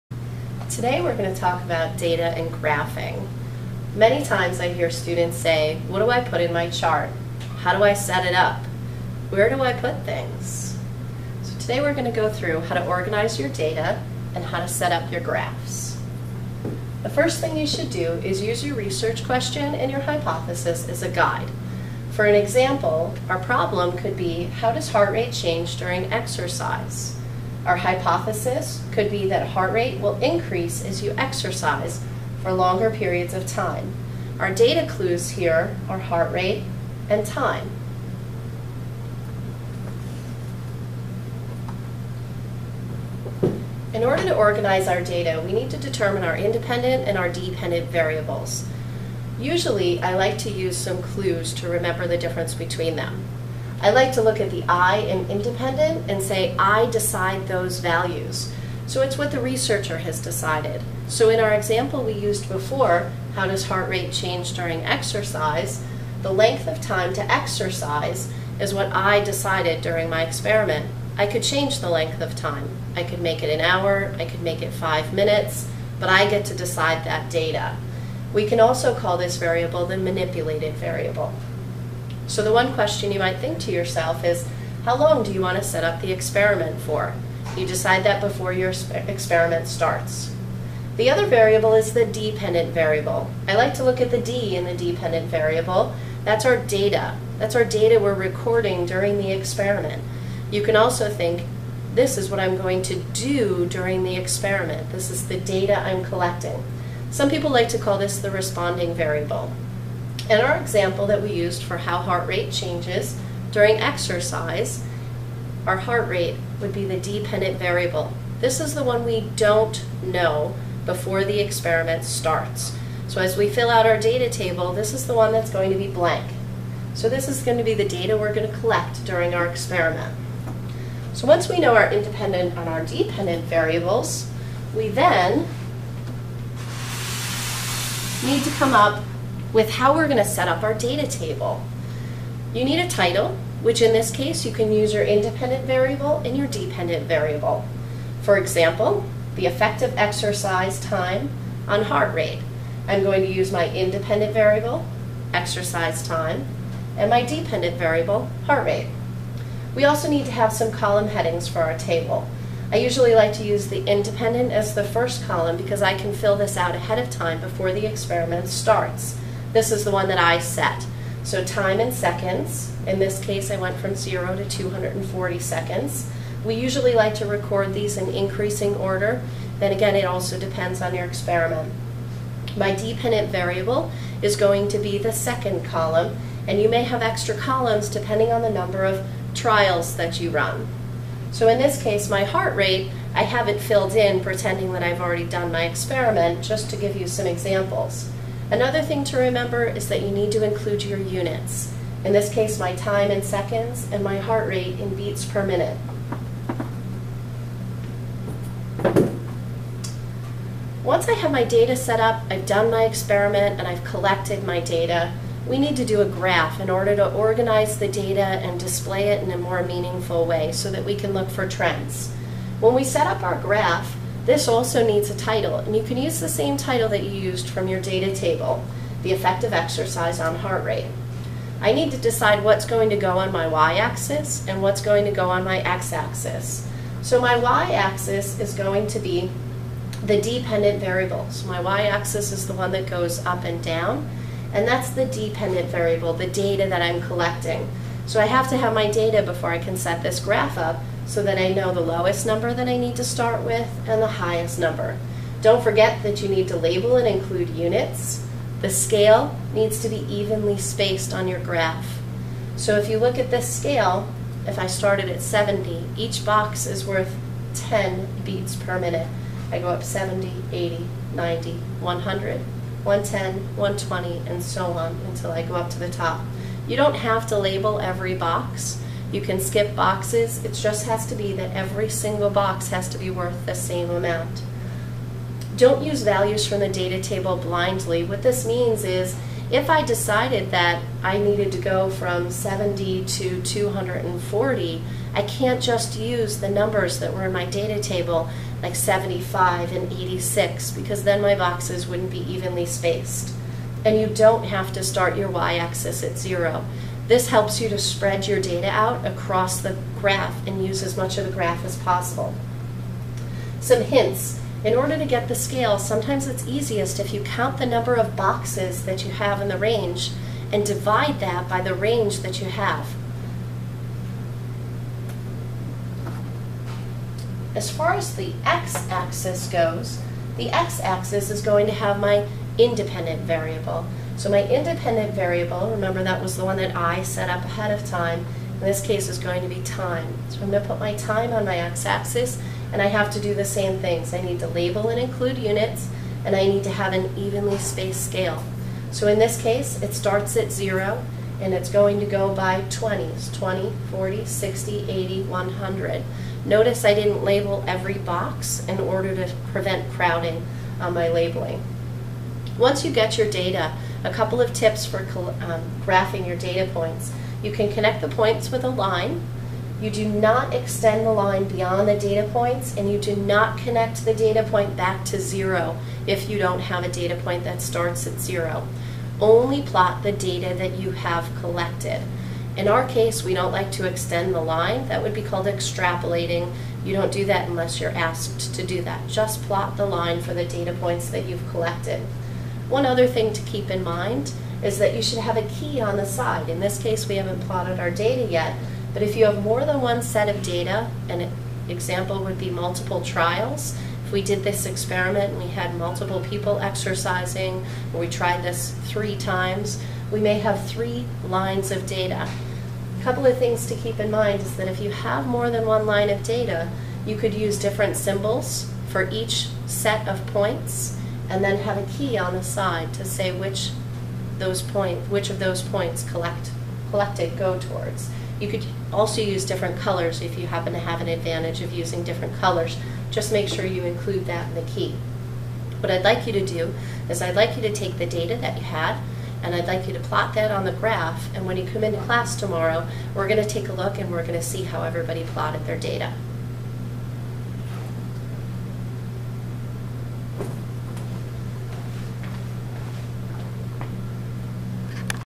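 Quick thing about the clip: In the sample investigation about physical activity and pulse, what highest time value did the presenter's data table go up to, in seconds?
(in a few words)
240.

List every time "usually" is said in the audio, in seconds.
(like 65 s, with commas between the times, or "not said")
49 s, 162 s, 176 s.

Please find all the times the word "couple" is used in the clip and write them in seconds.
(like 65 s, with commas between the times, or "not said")
364 s, 413 s.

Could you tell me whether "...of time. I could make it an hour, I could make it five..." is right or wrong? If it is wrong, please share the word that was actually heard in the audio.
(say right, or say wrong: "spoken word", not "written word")
right.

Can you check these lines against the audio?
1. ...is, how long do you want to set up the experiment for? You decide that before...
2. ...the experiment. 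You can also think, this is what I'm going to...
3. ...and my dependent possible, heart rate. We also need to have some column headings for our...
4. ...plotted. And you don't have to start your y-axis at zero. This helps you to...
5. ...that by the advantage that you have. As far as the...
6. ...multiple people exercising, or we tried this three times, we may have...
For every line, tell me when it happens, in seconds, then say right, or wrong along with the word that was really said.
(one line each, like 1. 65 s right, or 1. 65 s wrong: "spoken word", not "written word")
1. 84 s right
2. 99 s right
3. 156 s wrong: "variable", not "possible"
4. 302 s wrong: "spaced", not "plotted"
5. 321 s wrong: "range", not "advantage"
6. 405 s right.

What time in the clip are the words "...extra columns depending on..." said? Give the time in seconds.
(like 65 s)
187 s.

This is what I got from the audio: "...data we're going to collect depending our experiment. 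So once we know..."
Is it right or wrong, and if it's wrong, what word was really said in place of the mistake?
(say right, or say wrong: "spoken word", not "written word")
wrong: "during", not "depending".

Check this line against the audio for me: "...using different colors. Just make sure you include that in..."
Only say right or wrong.
right.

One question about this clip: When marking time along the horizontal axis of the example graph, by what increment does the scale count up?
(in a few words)
20.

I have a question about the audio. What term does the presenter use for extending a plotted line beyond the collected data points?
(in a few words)
extrapolating.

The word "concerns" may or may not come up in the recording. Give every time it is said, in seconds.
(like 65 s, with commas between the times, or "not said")
not said.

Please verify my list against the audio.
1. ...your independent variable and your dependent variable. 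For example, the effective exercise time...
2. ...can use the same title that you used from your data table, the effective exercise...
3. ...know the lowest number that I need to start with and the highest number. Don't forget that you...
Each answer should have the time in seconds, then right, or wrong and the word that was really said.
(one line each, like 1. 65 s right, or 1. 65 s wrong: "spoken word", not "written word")
1. 144 s right
2. 225 s right
3. 251 s right.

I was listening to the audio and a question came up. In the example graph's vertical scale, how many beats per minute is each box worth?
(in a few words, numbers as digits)
10.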